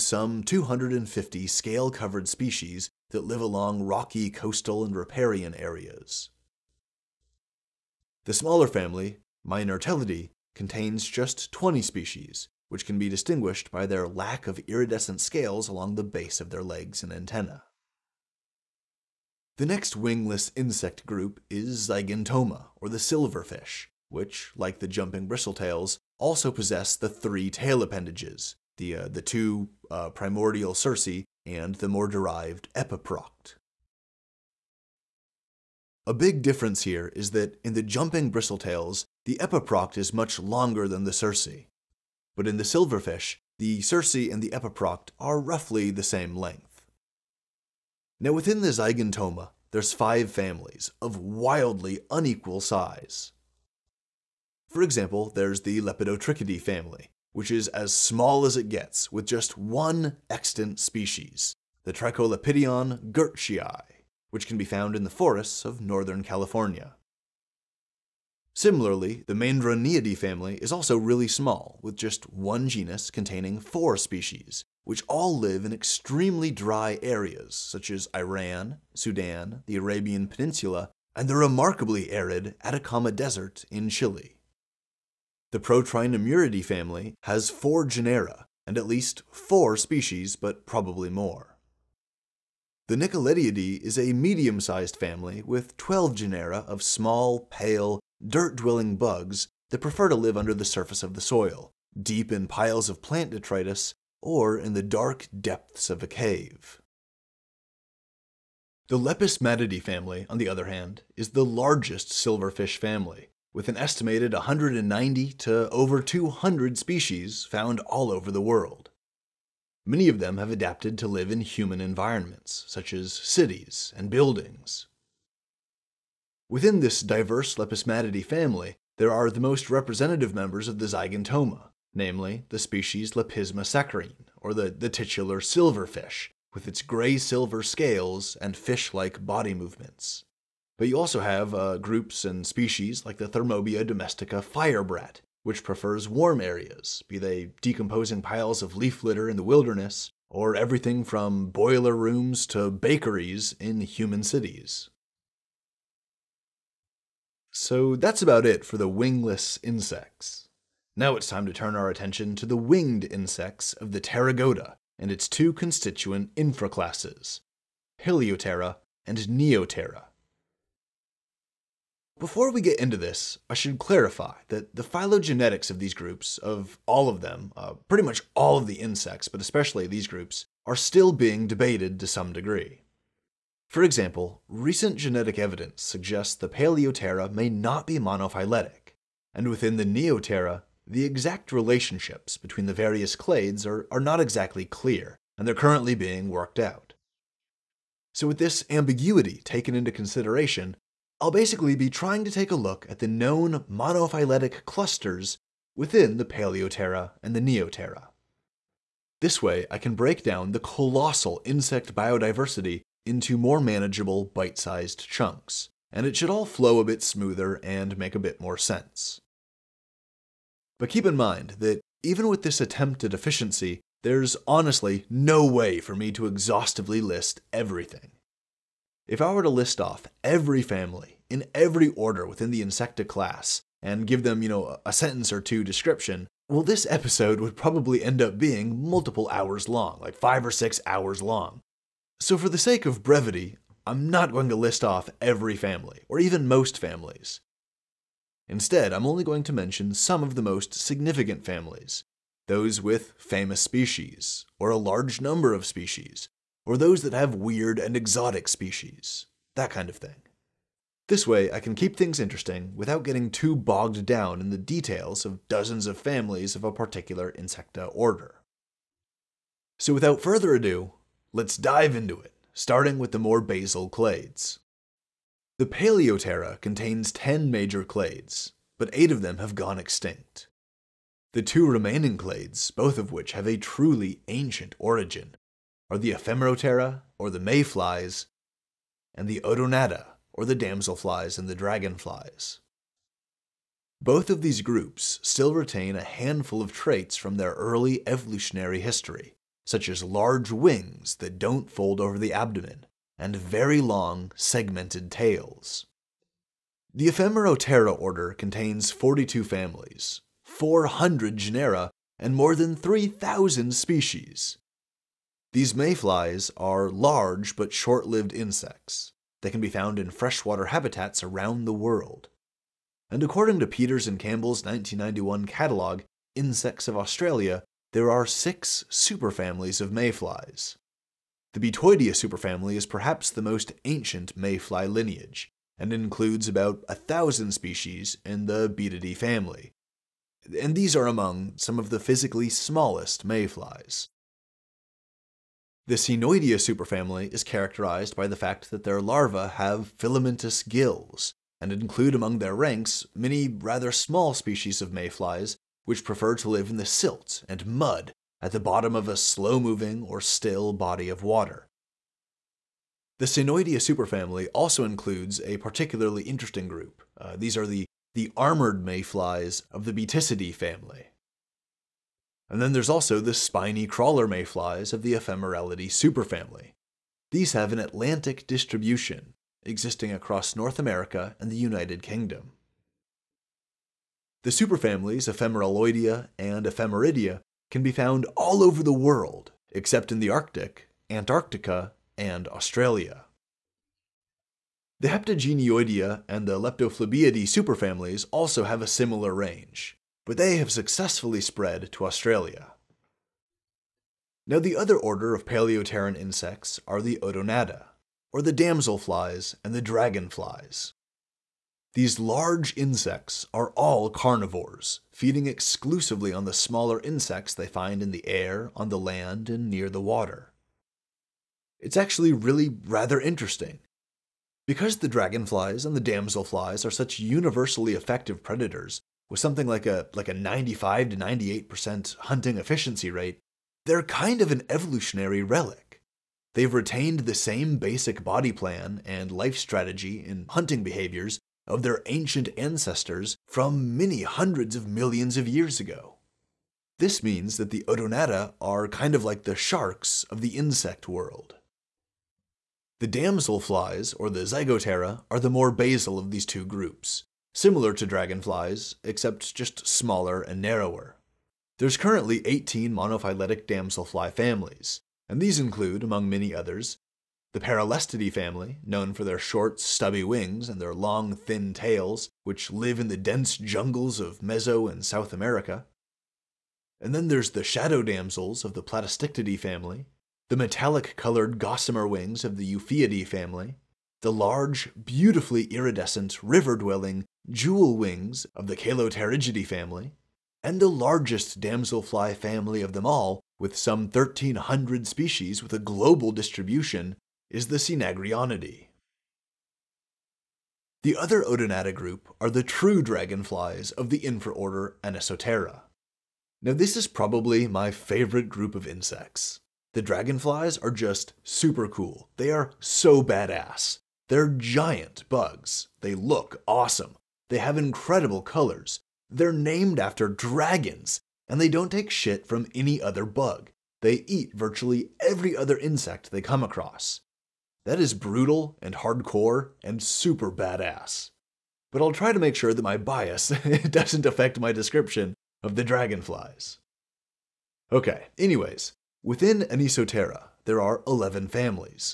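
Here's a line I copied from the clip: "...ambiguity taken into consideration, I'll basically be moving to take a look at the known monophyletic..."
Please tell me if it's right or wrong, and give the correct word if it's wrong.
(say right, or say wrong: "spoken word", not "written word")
wrong: "trying", not "moving".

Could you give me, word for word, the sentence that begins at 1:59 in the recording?
Many of them have adapted to live in human environments, such as cities and buildings.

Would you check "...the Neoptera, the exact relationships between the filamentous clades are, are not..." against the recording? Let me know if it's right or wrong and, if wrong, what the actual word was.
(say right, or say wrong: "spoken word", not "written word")
wrong: "various", not "filamentous".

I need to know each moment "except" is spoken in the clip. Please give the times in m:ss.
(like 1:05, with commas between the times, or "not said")
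6:29, 7:39.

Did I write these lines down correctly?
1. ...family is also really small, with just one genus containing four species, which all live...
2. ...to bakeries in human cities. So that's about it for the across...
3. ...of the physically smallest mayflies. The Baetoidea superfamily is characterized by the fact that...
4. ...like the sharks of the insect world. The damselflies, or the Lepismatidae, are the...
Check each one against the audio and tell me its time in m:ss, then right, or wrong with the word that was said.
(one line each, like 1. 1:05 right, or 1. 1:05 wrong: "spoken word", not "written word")
1. 1:10 right
2. 2:32 wrong: "wingless", not "across"
3. 5:41 wrong: "Caenoidea", not "Baetoidea"
4. 7:29 wrong: "Zygoptera", not "Lepismatidae".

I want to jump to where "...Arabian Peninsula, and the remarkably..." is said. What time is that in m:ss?
1:19.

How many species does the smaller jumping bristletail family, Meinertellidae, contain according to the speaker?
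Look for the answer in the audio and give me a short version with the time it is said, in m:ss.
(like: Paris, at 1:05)
20, at 0:11.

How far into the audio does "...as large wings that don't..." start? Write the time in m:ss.
4:59.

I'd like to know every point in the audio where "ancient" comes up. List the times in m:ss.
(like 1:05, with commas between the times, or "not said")
4:44, 5:33, 7:22.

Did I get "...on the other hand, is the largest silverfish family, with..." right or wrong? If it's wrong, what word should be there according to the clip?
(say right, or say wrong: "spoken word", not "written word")
right.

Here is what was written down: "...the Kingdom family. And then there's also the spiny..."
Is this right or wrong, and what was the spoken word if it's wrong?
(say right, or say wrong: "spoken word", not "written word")
wrong: "Baetiscidae", not "Kingdom".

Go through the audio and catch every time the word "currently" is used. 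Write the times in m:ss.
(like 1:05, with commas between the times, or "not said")
3:15, 7:41.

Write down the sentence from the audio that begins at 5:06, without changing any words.
The Ephemeroptera order contains 42 families, 400 genera, and more than 3,000 species.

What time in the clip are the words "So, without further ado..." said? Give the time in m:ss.
4:29.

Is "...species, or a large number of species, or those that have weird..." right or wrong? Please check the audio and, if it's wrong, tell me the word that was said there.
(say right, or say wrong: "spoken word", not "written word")
right.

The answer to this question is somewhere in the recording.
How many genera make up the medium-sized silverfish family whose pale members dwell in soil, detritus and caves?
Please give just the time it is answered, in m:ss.
1:35.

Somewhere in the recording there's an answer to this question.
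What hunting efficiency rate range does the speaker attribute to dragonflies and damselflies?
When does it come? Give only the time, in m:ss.
7:10.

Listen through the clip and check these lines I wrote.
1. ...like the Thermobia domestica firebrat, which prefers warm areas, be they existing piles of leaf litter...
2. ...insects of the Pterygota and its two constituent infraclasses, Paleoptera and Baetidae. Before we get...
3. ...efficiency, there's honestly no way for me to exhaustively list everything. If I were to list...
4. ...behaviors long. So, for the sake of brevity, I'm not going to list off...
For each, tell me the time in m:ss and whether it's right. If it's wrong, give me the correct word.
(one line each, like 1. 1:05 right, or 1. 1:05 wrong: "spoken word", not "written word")
1. 2:23 wrong: "decomposing", not "existing"
2. 2:43 wrong: "Neoptera", not "Baetidae"
3. 3:43 right
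4. 4:00 wrong: "hours", not "behaviors".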